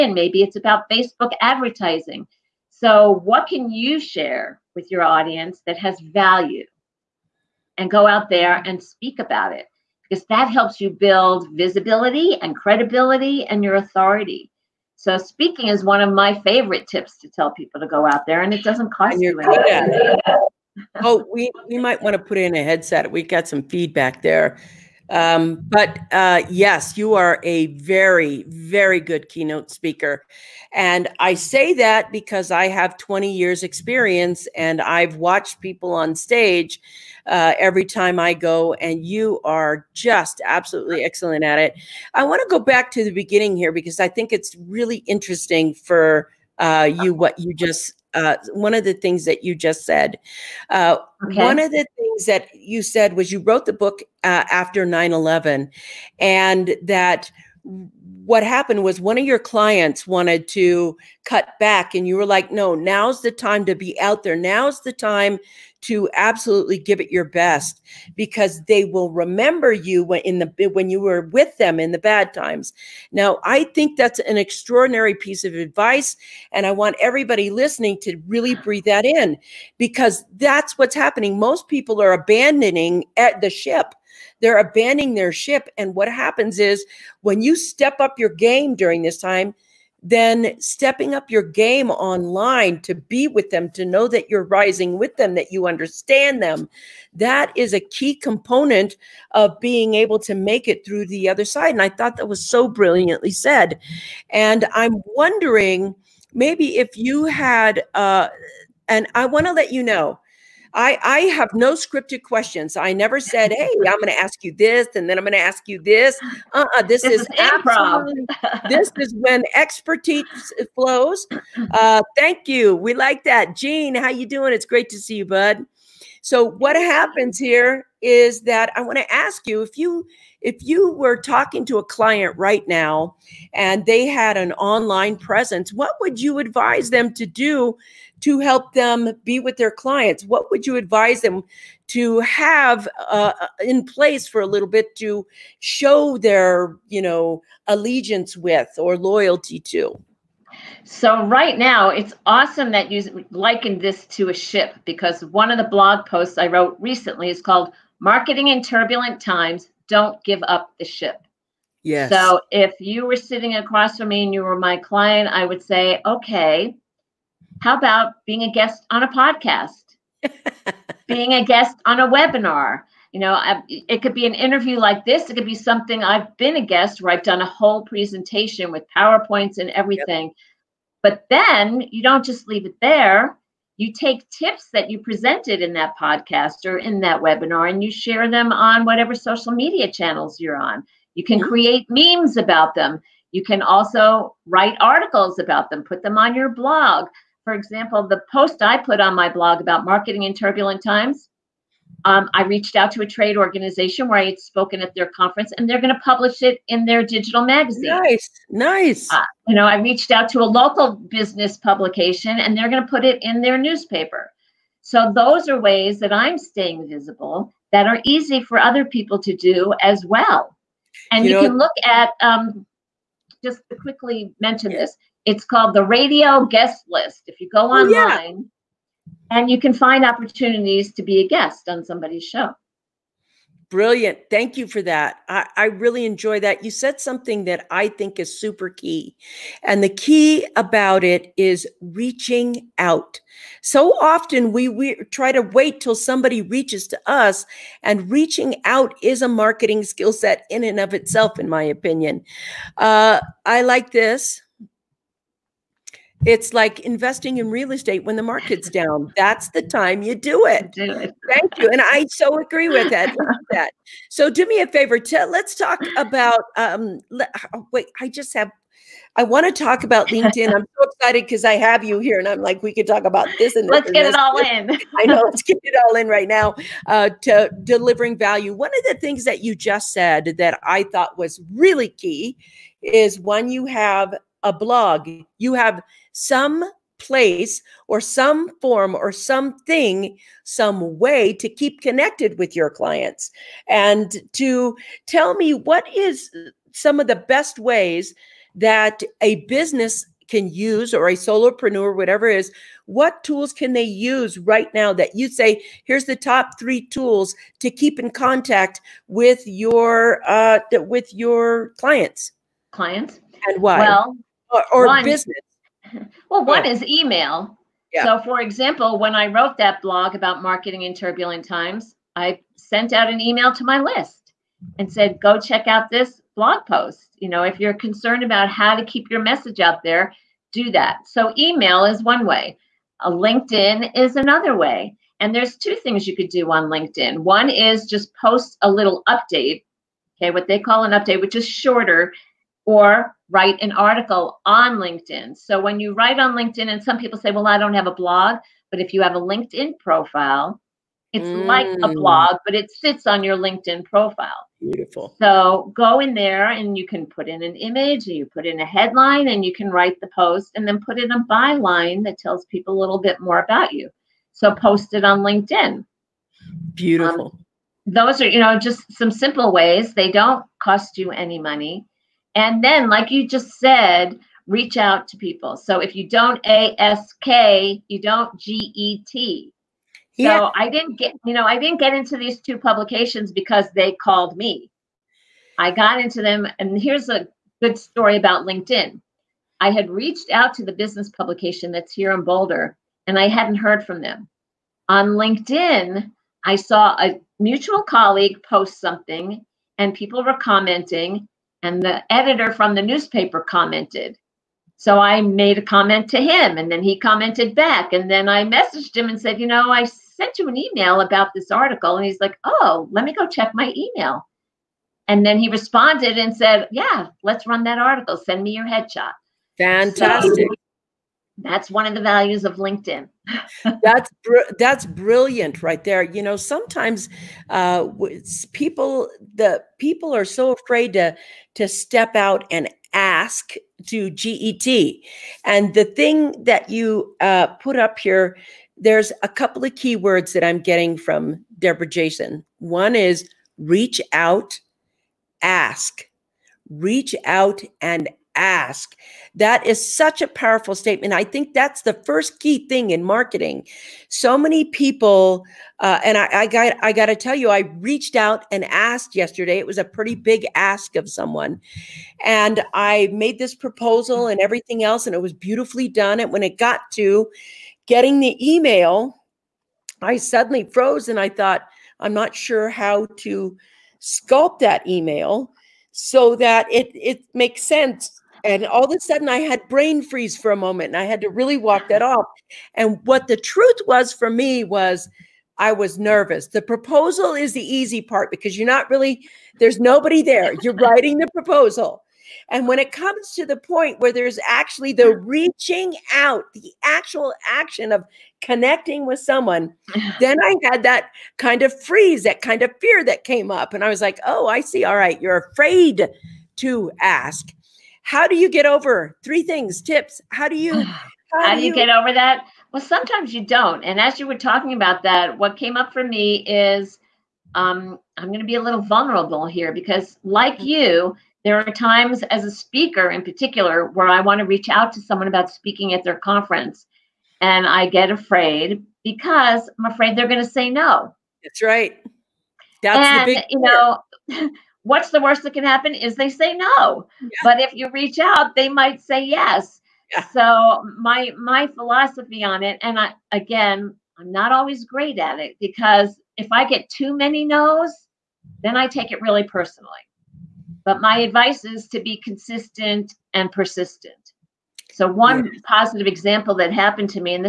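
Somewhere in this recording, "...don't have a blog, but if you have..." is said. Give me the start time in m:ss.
5:47.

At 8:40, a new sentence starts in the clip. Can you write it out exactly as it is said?
you, there are times as a speaker in particular where I want to reach out to someone about speaking at their conference.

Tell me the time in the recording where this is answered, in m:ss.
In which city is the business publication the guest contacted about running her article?
6:32.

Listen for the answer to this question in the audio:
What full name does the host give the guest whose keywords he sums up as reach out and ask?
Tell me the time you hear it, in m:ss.
7:21.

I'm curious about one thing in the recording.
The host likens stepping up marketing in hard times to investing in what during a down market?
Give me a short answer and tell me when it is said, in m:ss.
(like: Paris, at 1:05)
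Real estate, at 4:17.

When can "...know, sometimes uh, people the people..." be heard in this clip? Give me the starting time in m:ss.
7:06.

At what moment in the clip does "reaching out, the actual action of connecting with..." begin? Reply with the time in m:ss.
8:15.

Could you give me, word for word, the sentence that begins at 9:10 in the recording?
But my advice is to be consistent and persistent.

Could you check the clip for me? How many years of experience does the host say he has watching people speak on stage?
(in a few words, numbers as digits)
20.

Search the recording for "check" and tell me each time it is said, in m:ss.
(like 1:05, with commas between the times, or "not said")
5:25, 6:53.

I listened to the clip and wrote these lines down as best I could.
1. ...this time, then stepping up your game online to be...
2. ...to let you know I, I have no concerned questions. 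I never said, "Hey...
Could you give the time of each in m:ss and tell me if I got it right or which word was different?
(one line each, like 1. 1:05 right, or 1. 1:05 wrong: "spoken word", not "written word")
1. 1:29 right
2. 1:49 wrong: "scripted", not "concerned".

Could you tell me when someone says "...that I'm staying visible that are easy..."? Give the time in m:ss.
3:35.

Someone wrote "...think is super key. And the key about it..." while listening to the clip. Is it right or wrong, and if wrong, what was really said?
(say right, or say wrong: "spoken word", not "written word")
right.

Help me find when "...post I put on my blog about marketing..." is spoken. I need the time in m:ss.
3:18.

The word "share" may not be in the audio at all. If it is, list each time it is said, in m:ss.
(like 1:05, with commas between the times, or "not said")
0:03, 3:07.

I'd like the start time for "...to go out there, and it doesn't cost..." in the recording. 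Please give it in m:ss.
0:17.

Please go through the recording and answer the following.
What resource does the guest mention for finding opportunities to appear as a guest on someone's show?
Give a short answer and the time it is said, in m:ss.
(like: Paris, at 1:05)
Radio Guest List, at 3:45.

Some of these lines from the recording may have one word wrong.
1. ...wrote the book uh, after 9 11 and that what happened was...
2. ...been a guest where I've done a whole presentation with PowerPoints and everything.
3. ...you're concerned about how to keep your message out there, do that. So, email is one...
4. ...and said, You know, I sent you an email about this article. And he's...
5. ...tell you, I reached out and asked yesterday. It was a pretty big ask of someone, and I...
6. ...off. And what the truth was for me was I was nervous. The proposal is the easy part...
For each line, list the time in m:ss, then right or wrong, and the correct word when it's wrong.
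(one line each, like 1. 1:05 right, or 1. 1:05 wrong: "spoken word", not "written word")
1. 0:53 right
2. 2:56 right
3. 5:27 right
4. 6:49 right
5. 7:37 right
6. 8:02 right.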